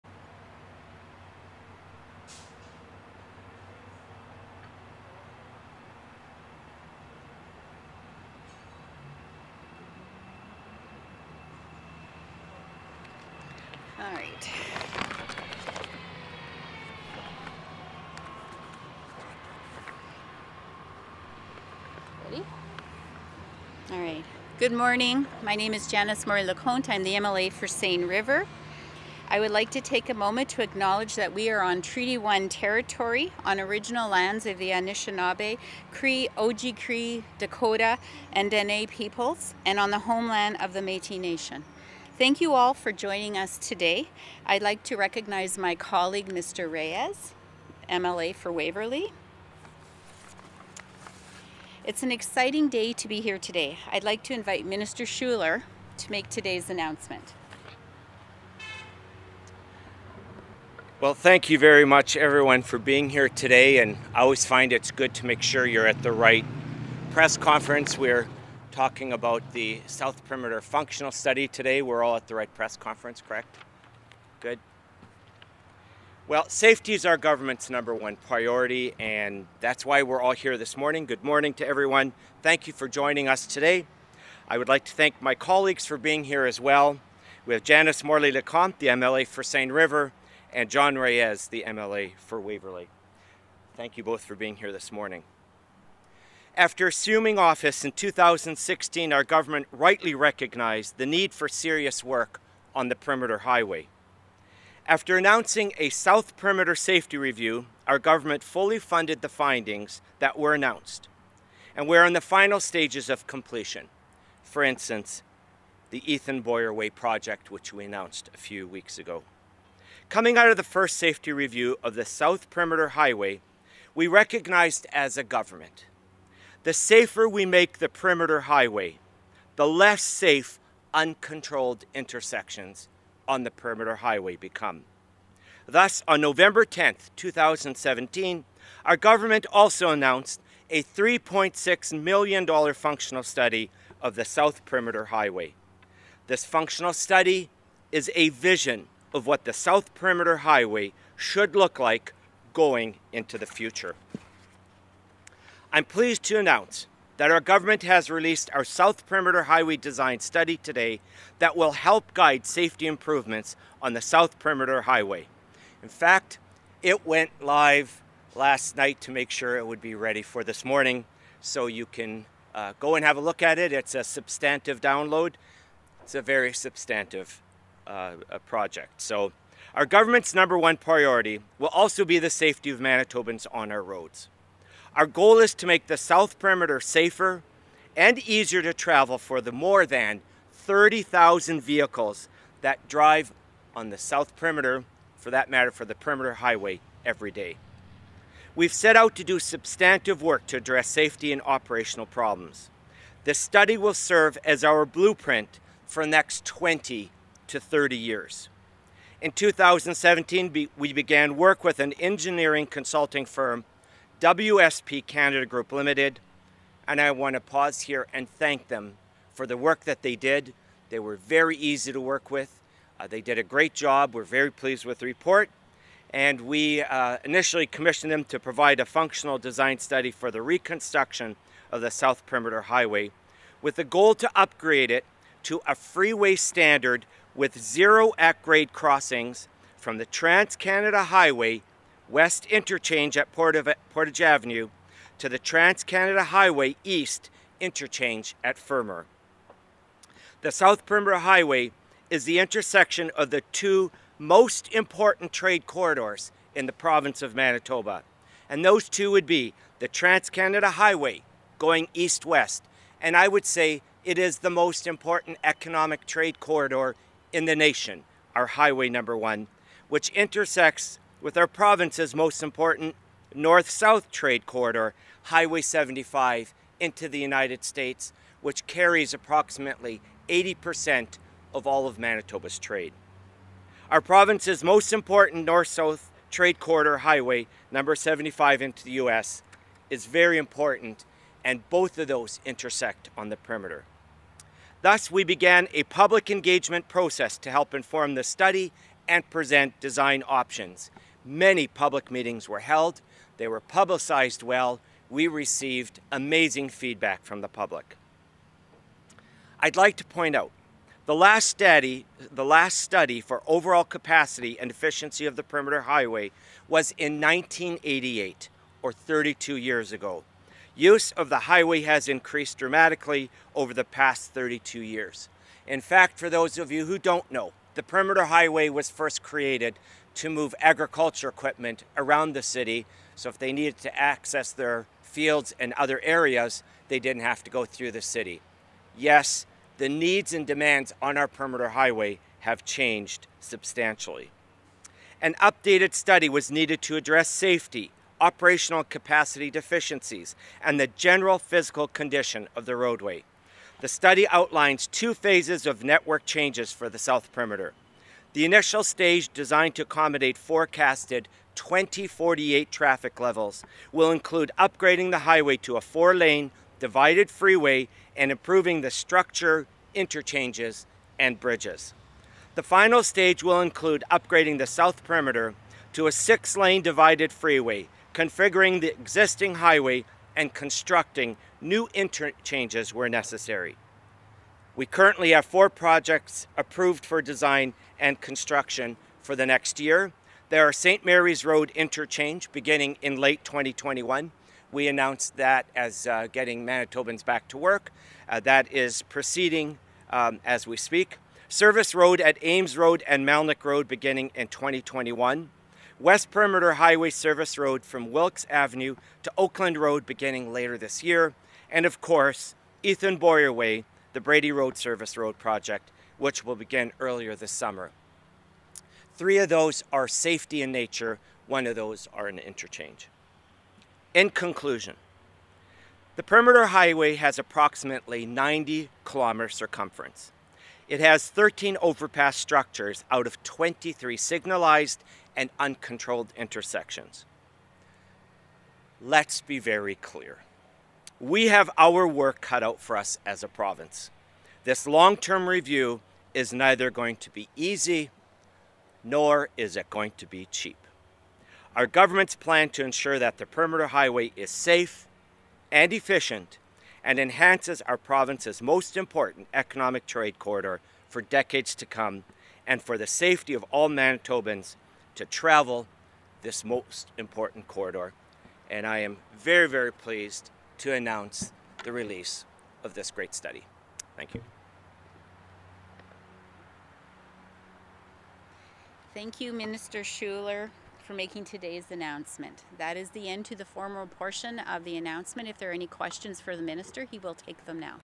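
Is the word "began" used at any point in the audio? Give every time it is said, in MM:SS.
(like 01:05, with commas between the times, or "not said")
03:30, 04:55.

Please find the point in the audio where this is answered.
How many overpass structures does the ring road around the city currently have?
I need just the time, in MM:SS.
07:11.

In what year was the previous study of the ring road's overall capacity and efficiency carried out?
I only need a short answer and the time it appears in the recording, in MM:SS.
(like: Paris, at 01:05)
1988, at 05:17.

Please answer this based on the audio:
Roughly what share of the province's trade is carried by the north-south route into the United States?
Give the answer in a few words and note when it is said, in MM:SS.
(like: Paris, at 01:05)
80%, at 04:40.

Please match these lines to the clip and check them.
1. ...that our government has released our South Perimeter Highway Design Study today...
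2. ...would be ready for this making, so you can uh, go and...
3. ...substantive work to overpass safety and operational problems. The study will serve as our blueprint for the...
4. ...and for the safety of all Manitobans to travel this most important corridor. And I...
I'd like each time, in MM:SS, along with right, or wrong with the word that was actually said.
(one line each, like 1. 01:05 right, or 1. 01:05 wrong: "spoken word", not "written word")
1. 02:37 right
2. 02:49 wrong: "morning", not "making"
3. 03:19 wrong: "address", not "overpass"
4. 07:42 right.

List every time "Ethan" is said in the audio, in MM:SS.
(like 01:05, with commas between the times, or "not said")
01:56, 06:52.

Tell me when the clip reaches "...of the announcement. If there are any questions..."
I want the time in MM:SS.
08:04.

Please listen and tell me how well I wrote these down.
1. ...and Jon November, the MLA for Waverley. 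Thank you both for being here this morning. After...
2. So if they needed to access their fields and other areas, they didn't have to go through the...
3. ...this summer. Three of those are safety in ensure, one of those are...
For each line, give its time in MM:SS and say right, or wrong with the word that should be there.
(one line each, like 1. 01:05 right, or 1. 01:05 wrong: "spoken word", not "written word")
1. 01:30 wrong: "Reyes", not "November"
2. 05:33 right
3. 06:57 wrong: "nature", not "ensure".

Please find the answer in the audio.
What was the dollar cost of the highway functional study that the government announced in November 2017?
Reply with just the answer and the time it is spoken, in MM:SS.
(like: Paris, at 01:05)
$3.6 million, at 02:20.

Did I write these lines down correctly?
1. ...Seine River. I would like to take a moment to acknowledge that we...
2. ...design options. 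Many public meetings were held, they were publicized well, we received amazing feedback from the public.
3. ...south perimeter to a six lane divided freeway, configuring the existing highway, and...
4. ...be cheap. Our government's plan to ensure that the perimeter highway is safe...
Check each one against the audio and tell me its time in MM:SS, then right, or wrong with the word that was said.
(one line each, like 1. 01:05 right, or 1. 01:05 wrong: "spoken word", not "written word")
1. 00:27 right
2. 04:59 right
3. 06:14 right
4. 07:30 right.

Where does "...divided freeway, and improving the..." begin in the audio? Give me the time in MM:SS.
06:06.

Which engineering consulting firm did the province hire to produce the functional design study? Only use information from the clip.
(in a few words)
WSP Canada Group Limited.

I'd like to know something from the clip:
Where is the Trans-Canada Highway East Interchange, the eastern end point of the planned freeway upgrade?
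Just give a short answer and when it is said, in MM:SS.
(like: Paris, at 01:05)
Fermor, at 04:08.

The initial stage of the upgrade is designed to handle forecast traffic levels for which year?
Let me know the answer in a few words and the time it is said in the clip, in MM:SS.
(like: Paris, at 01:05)
2048, at 06:01.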